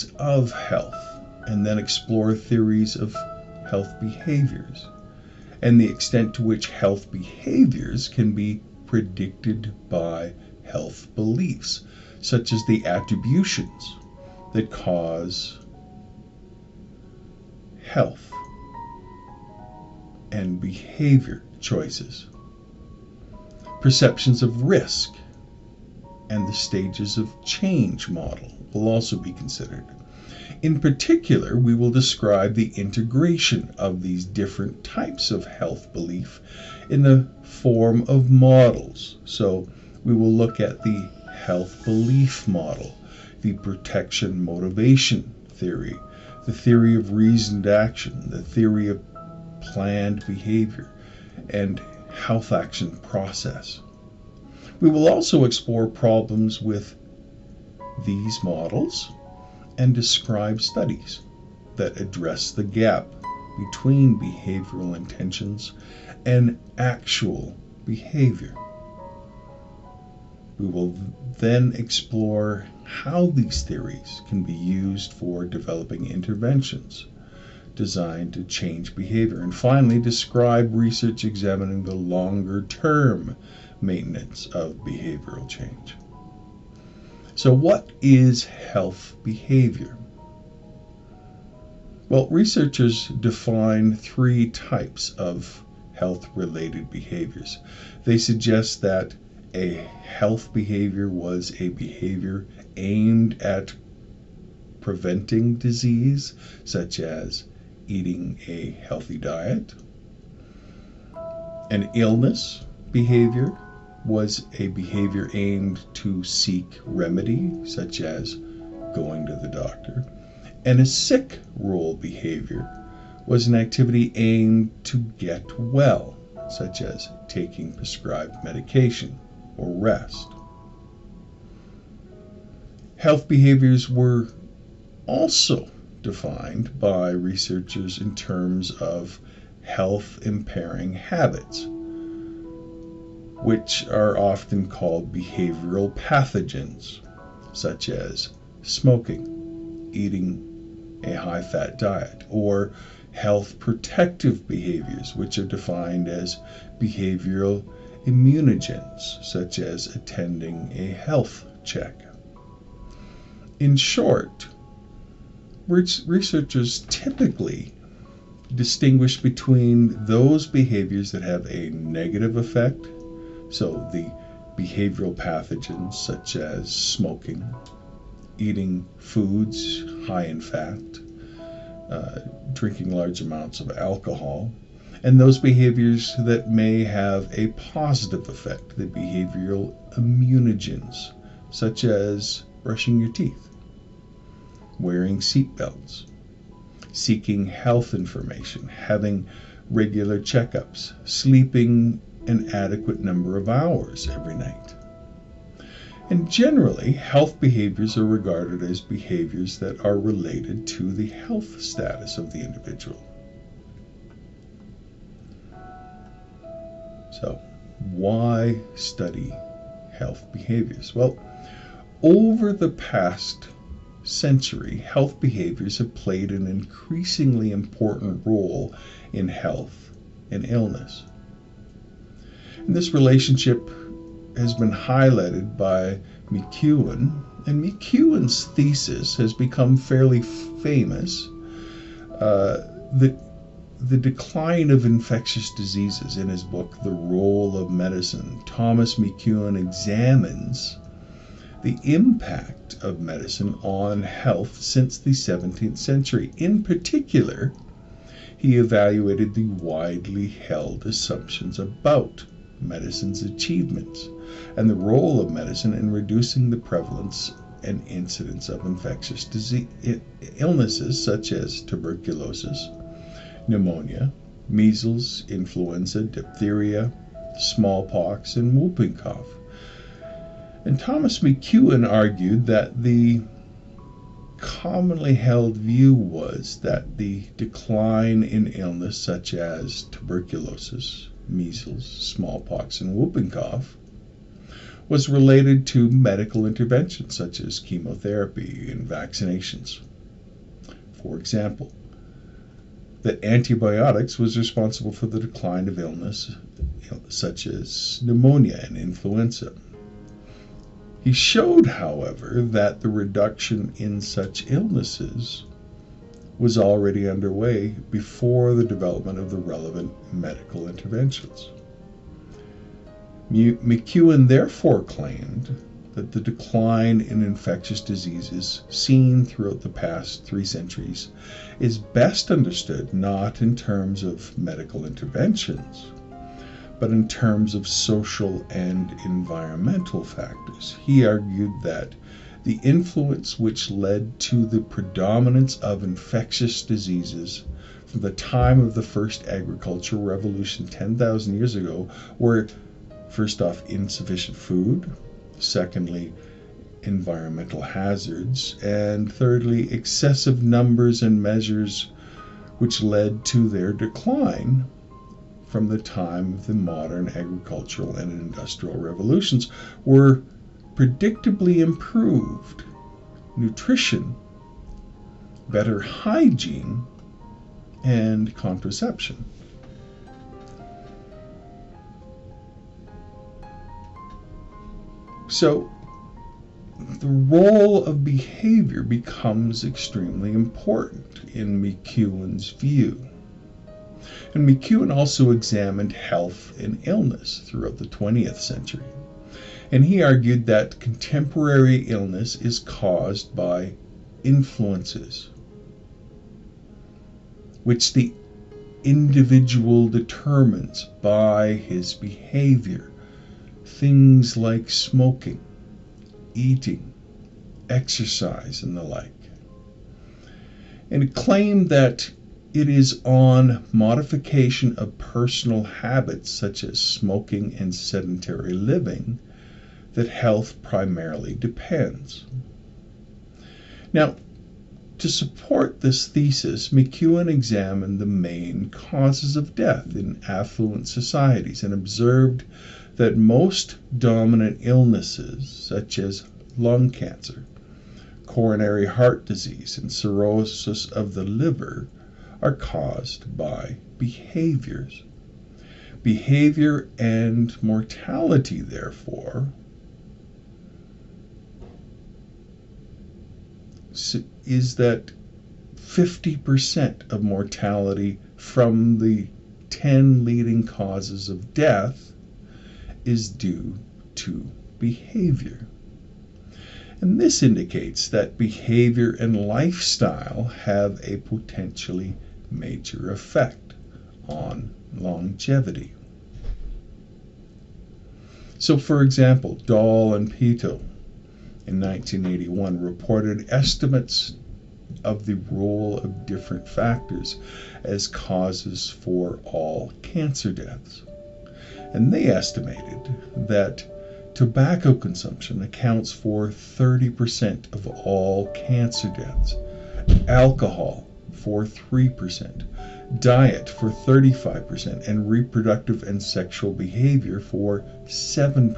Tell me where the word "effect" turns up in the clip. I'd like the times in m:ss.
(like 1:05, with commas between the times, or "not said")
2:52, 3:08, 8:03.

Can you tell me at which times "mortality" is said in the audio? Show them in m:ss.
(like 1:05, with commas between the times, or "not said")
7:37, 7:47.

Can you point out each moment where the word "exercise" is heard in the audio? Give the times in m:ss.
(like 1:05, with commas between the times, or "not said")
6:57.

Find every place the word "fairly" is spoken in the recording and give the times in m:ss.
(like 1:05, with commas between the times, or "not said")
3:59.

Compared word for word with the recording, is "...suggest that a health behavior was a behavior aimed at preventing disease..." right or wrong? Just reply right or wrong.
right.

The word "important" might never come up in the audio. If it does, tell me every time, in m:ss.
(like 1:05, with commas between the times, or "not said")
3:47, 6:30.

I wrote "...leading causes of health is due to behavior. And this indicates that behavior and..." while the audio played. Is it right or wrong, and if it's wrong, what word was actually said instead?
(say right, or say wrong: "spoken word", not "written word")
wrong: "death", not "health".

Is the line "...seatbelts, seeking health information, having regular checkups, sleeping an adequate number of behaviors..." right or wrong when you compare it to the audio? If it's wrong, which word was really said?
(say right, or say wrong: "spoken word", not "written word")
wrong: "hours", not "behaviors".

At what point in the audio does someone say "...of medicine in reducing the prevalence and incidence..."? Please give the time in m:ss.
4:25.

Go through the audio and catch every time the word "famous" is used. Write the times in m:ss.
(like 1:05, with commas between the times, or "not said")
4:00.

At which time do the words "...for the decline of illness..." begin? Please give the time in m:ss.
5:04.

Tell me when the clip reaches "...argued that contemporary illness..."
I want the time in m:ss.
6:40.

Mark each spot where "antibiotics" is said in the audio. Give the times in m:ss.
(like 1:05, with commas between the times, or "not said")
5:03.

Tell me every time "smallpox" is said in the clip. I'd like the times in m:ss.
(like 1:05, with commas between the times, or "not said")
4:37, 4:51.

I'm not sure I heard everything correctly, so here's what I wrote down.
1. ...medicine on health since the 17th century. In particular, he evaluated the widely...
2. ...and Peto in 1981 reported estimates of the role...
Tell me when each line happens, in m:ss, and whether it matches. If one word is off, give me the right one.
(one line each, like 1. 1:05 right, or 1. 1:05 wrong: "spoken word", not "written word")
1. 4:13 right
2. 8:10 right.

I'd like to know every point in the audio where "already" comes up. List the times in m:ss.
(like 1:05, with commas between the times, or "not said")
5:16.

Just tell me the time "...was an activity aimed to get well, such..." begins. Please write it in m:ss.
2:03.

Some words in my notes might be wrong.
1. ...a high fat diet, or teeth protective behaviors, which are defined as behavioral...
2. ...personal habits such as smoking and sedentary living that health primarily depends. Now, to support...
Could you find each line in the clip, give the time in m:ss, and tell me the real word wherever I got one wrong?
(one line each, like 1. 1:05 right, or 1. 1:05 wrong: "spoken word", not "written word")
1. 2:31 wrong: "health", not "teeth"
2. 7:04 right.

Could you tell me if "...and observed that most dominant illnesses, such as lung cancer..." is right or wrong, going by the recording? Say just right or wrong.
right.